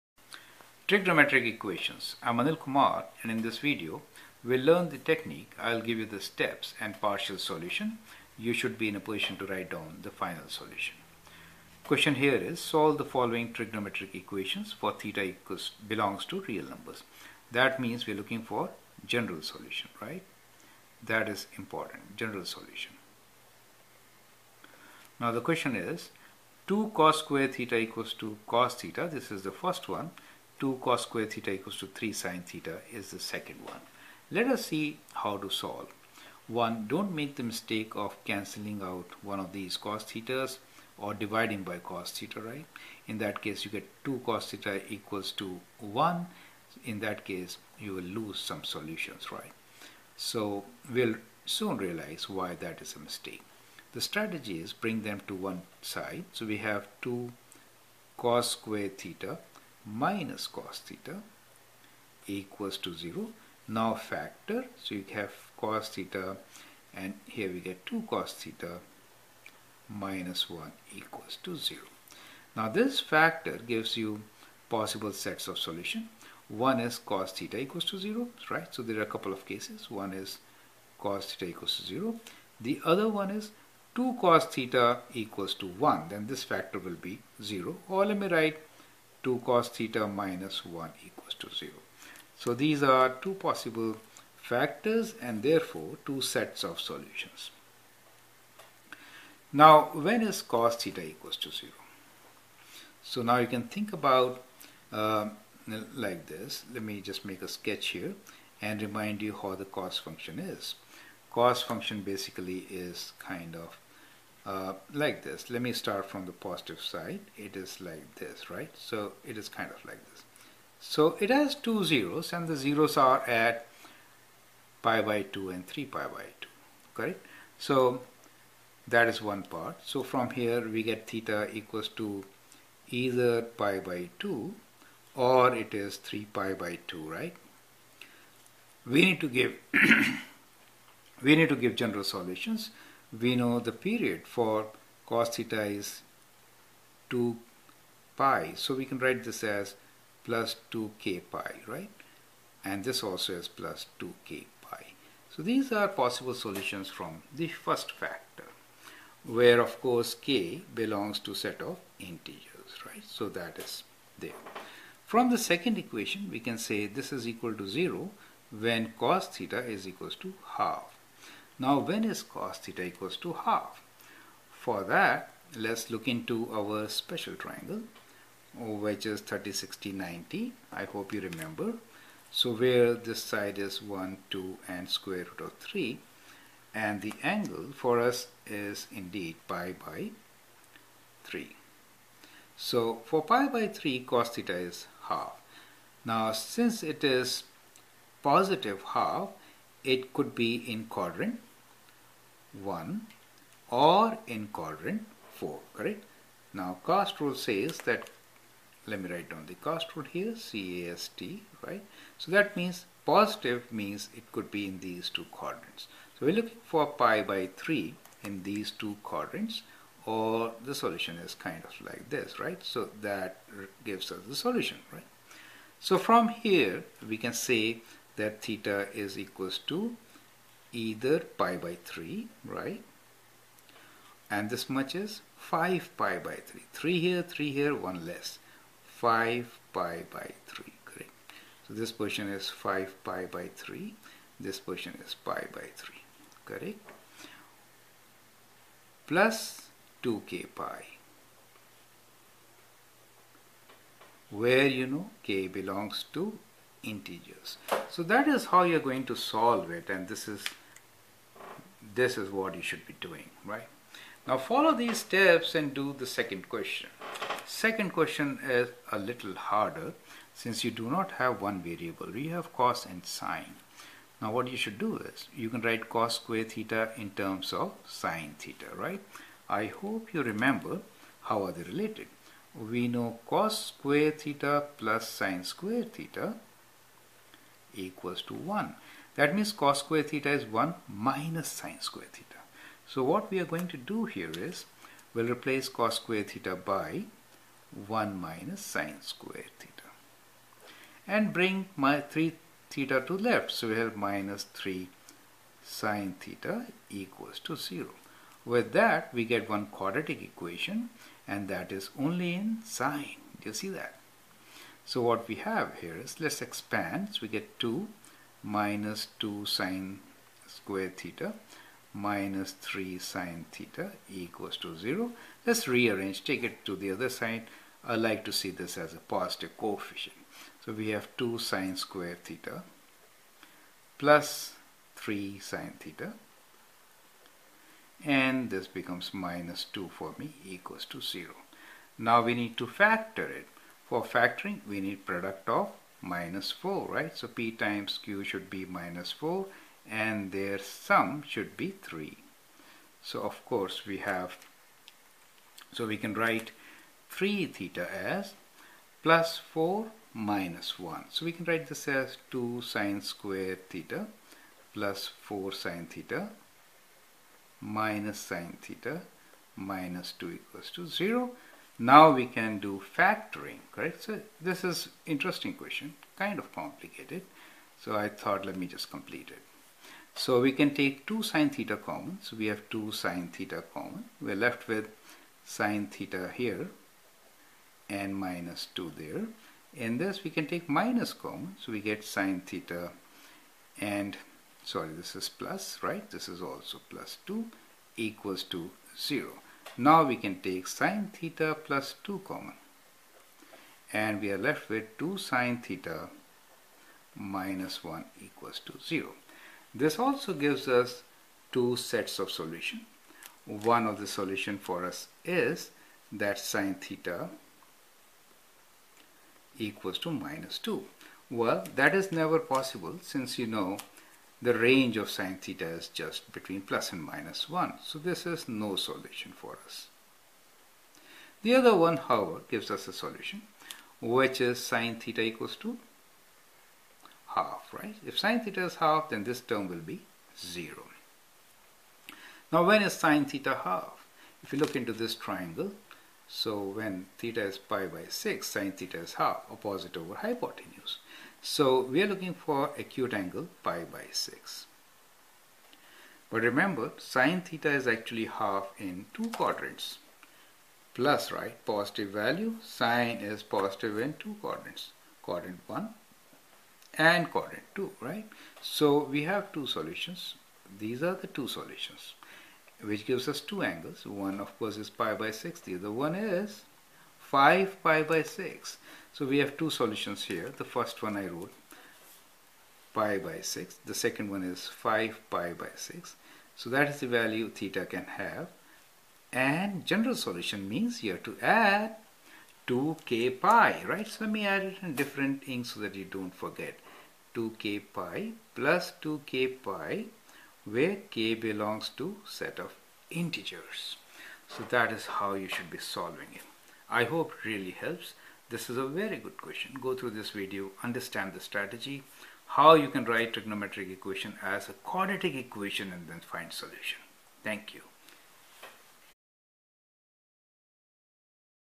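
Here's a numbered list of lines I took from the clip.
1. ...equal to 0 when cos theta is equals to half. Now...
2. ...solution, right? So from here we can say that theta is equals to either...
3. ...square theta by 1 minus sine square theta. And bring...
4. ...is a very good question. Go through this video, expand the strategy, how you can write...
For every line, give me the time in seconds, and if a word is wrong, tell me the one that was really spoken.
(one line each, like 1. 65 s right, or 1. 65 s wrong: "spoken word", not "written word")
1. 167 s right
2. 224 s right
3. 295 s right
4. 508 s wrong: "understand", not "expand".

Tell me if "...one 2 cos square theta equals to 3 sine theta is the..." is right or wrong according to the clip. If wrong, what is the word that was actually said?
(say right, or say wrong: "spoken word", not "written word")
right.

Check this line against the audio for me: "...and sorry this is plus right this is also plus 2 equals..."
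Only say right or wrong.
right.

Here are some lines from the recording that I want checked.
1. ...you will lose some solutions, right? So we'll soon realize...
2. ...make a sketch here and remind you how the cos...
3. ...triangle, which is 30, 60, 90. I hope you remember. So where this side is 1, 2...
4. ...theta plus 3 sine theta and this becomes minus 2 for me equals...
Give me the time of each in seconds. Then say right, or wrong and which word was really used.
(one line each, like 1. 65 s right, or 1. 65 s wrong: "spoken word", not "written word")
1. 47 s right
2. 107 s right
3. 177 s right
4. 332 s right.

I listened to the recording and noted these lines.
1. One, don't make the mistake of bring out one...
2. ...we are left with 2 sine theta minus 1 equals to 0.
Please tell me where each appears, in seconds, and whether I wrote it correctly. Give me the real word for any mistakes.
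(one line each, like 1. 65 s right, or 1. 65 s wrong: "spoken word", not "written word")
1. 36 s wrong: "cancelling", not "bring"
2. 404 s right.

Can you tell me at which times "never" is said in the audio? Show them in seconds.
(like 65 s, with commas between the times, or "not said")
422 s.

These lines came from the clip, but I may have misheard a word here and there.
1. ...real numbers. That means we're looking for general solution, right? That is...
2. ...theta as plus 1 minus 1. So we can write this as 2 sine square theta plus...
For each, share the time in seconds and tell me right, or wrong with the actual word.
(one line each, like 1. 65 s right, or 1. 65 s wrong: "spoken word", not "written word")
1. 16 s right
2. 357 s wrong: "4", not "1".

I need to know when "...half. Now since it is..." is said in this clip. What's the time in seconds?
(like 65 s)
195 s.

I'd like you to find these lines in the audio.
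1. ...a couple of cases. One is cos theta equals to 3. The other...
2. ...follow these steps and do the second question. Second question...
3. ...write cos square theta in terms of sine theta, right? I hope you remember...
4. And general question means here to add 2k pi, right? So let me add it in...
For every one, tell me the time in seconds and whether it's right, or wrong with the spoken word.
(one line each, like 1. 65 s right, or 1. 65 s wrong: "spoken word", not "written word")
1. 79 s wrong: "0", not "3"
2. 264 s right
3. 275 s right
4. 489 s wrong: "solution", not "question".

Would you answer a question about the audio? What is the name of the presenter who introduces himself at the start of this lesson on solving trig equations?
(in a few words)
Anil Kumar.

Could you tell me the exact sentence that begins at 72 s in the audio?
Now this factor gives you possible sets of solution.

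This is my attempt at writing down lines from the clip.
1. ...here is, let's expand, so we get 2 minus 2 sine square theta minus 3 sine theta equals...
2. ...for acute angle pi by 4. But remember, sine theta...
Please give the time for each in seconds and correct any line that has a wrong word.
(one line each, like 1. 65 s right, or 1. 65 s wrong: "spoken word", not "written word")
1. 315 s right
2. 452 s wrong: "6", not "4".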